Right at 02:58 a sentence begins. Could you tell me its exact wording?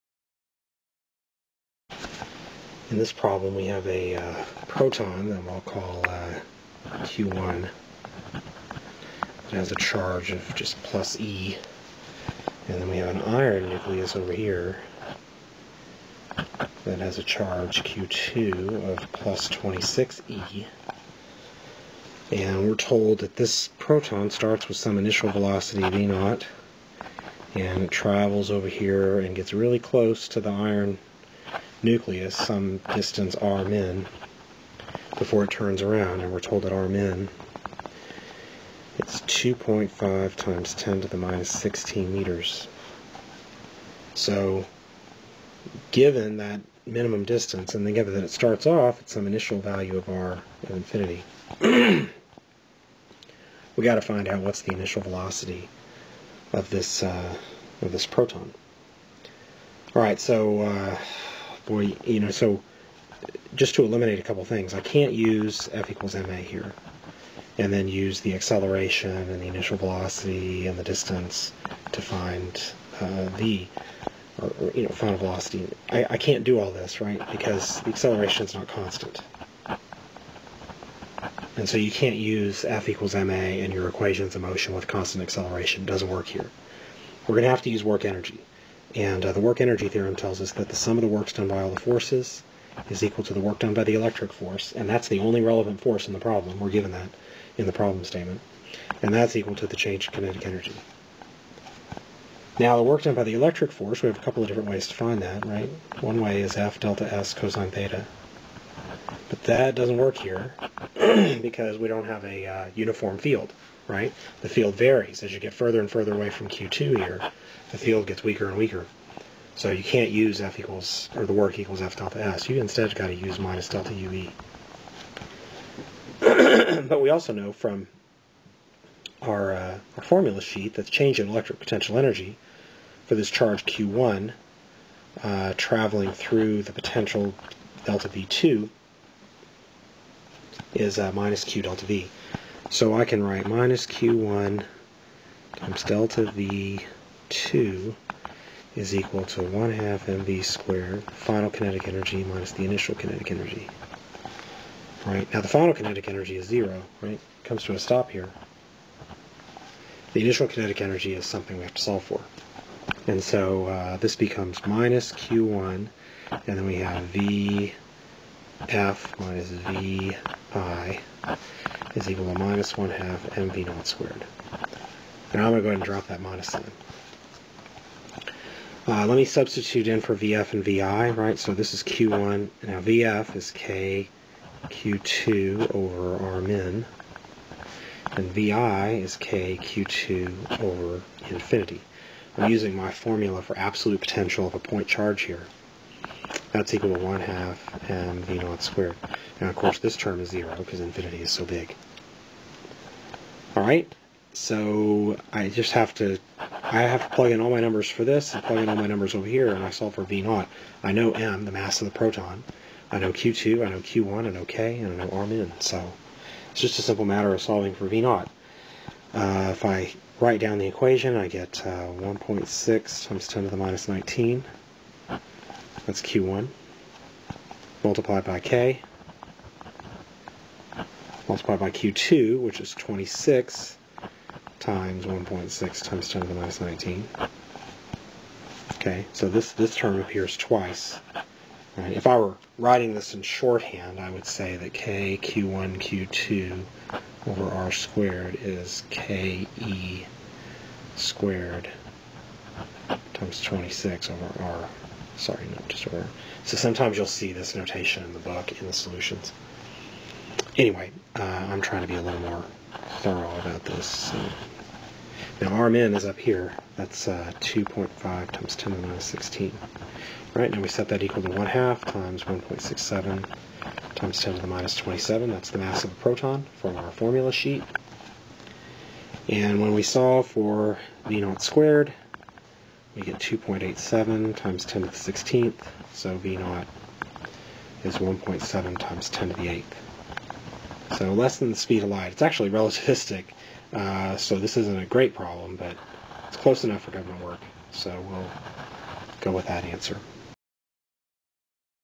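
Uh, let me substitute in for VF and VI, right?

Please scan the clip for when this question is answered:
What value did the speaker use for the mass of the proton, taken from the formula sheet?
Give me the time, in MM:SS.
04:32.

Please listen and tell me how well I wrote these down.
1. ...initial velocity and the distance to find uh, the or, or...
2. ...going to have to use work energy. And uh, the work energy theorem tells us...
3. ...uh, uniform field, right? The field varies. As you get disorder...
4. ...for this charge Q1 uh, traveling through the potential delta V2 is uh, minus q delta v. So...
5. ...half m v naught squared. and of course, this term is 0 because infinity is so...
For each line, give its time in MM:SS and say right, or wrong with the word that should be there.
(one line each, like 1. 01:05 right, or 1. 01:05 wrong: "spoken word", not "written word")
1. 01:09 right
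2. 01:27 right
3. 01:52 wrong: "further", not "disorder"
4. 02:13 right
5. 03:17 right.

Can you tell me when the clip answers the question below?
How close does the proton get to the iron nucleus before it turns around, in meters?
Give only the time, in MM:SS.
00:39.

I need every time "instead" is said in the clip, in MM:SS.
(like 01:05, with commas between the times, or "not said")
02:02.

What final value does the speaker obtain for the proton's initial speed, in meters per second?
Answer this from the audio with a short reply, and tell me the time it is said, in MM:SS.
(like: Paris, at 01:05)
1.7 × 10^8, at 04:47.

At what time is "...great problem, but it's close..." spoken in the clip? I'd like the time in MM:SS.
04:54.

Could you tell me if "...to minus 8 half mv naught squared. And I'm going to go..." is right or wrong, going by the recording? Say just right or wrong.
wrong.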